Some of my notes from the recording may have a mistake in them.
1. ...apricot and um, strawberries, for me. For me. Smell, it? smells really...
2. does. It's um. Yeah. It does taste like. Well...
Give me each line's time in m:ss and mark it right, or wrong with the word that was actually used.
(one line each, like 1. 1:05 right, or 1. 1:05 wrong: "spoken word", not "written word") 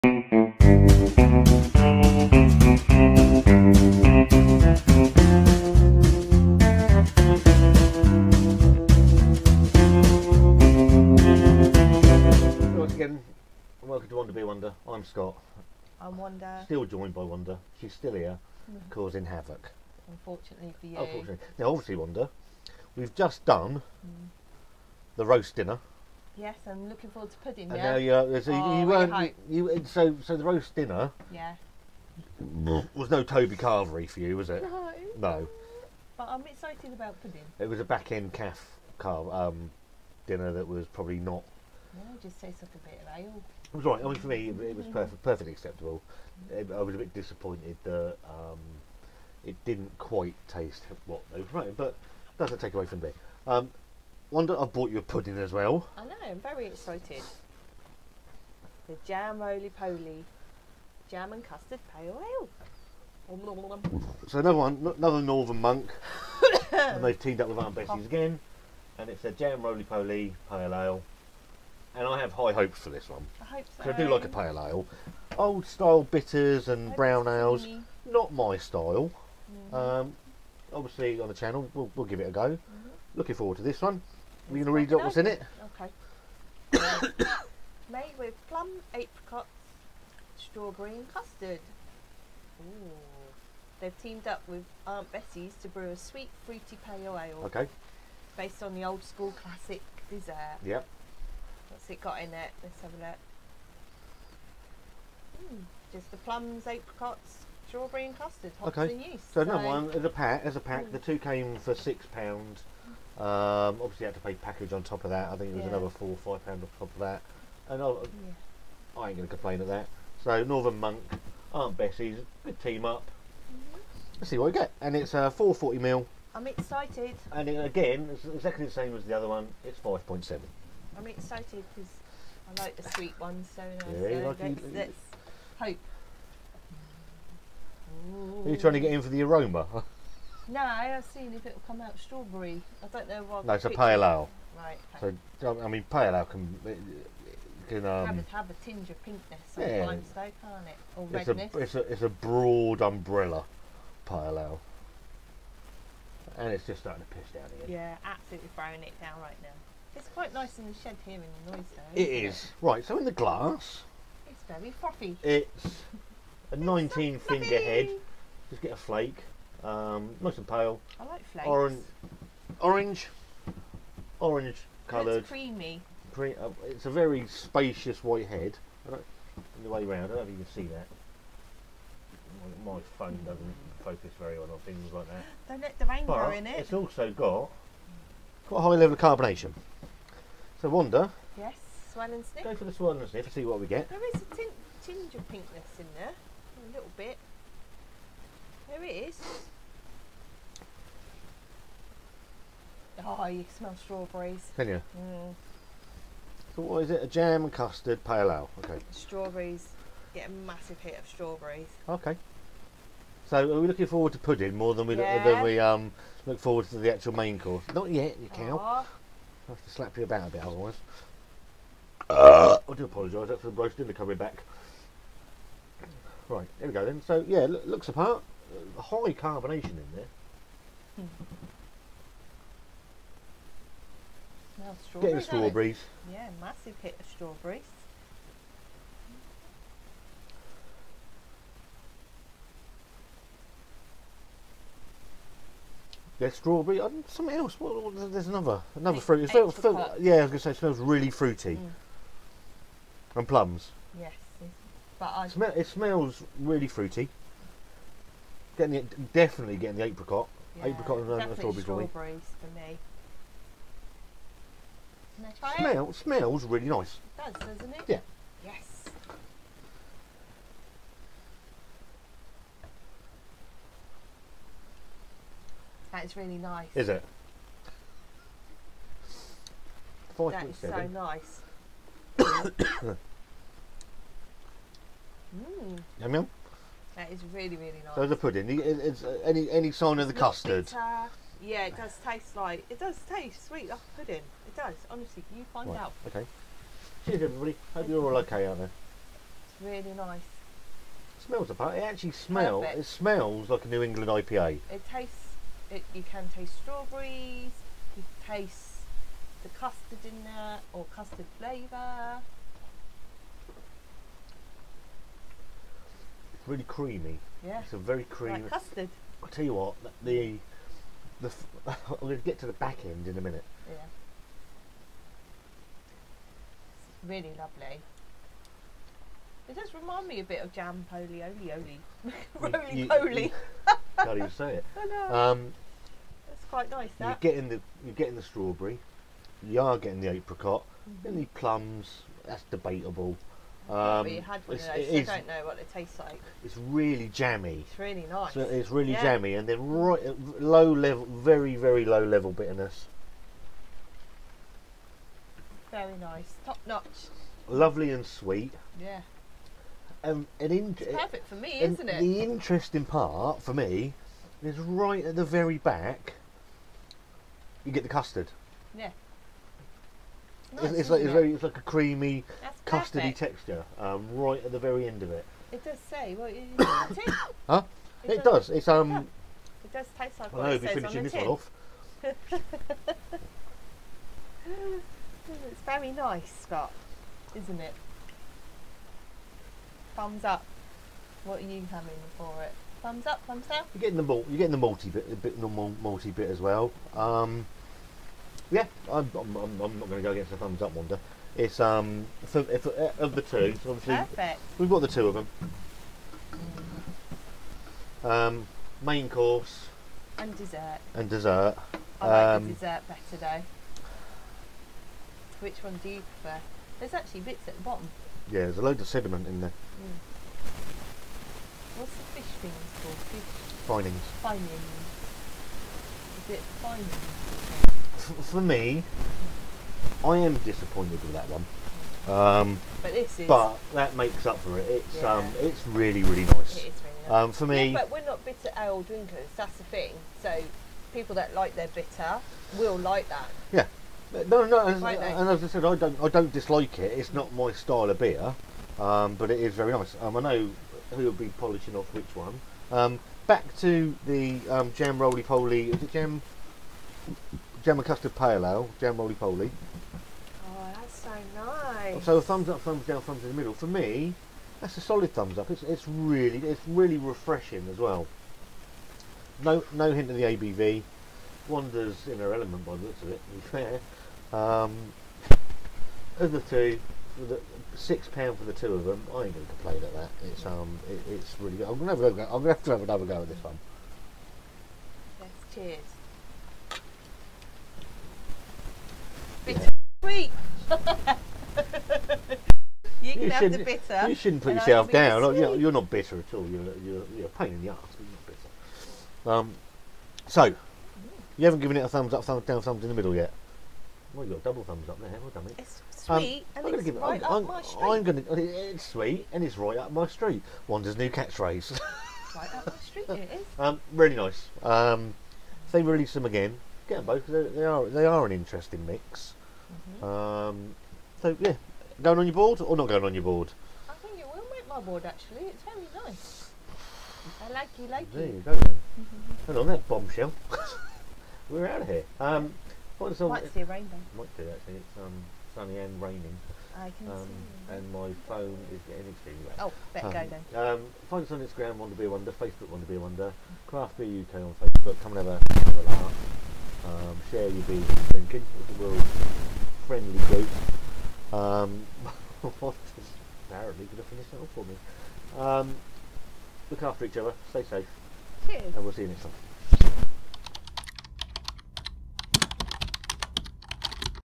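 1. 4:20 right
2. 6:18 right.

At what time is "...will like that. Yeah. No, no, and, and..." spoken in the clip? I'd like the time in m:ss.
7:22.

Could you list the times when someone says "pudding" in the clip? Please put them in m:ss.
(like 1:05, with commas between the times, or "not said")
0:27, 0:37, 0:55, 3:34, 4:48, 4:53.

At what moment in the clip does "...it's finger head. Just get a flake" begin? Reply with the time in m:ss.
2:47.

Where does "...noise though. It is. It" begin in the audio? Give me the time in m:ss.
2:41.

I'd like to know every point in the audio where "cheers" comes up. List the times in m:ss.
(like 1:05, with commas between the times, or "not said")
4:57, 8:05, 9:18.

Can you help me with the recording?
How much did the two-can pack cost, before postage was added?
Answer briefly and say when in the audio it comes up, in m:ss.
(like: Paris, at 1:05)
6 pounds, at 1:51.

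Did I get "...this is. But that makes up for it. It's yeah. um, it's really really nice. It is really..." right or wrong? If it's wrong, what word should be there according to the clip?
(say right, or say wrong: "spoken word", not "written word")
right.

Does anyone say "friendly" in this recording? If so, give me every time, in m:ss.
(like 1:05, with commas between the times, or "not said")
9:09.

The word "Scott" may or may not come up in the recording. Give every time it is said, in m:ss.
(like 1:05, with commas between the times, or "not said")
0:15, 6:26.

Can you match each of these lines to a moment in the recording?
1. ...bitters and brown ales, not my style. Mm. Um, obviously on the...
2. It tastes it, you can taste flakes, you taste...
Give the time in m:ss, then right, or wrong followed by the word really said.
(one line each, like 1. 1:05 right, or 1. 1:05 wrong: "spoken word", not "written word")
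1. 1:16 right
2. 5:04 wrong: "strawberries", not "flakes".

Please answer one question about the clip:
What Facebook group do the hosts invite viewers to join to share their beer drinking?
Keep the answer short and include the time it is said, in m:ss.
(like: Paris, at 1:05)
Craft Beer UK, at 9:03.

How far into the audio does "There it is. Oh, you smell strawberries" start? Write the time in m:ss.
3:18.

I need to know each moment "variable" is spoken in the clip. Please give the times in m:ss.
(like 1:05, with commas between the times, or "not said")
not said.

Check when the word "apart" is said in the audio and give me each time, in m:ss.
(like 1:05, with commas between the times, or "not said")
3:47, 5:01.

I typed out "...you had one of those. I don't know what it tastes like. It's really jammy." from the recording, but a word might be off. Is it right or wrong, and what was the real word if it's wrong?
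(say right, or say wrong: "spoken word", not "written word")
right.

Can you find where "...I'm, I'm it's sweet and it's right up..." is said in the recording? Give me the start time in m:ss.
8:27.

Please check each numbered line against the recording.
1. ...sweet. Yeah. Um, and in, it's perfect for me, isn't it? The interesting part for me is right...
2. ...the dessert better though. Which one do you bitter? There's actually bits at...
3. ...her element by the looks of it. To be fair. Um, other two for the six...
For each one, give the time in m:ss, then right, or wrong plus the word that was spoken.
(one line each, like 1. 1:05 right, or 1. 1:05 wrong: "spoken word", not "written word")
1. 5:58 right
2. 6:52 wrong: "prefer", not "bitter"
3. 7:52 right.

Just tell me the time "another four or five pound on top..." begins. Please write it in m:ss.
1:55.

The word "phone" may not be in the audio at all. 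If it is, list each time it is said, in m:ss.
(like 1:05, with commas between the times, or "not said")
3:02, 8:58.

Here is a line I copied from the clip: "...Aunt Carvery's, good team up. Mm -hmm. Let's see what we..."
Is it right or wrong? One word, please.
wrong.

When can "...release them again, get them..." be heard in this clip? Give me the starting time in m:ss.
8:35.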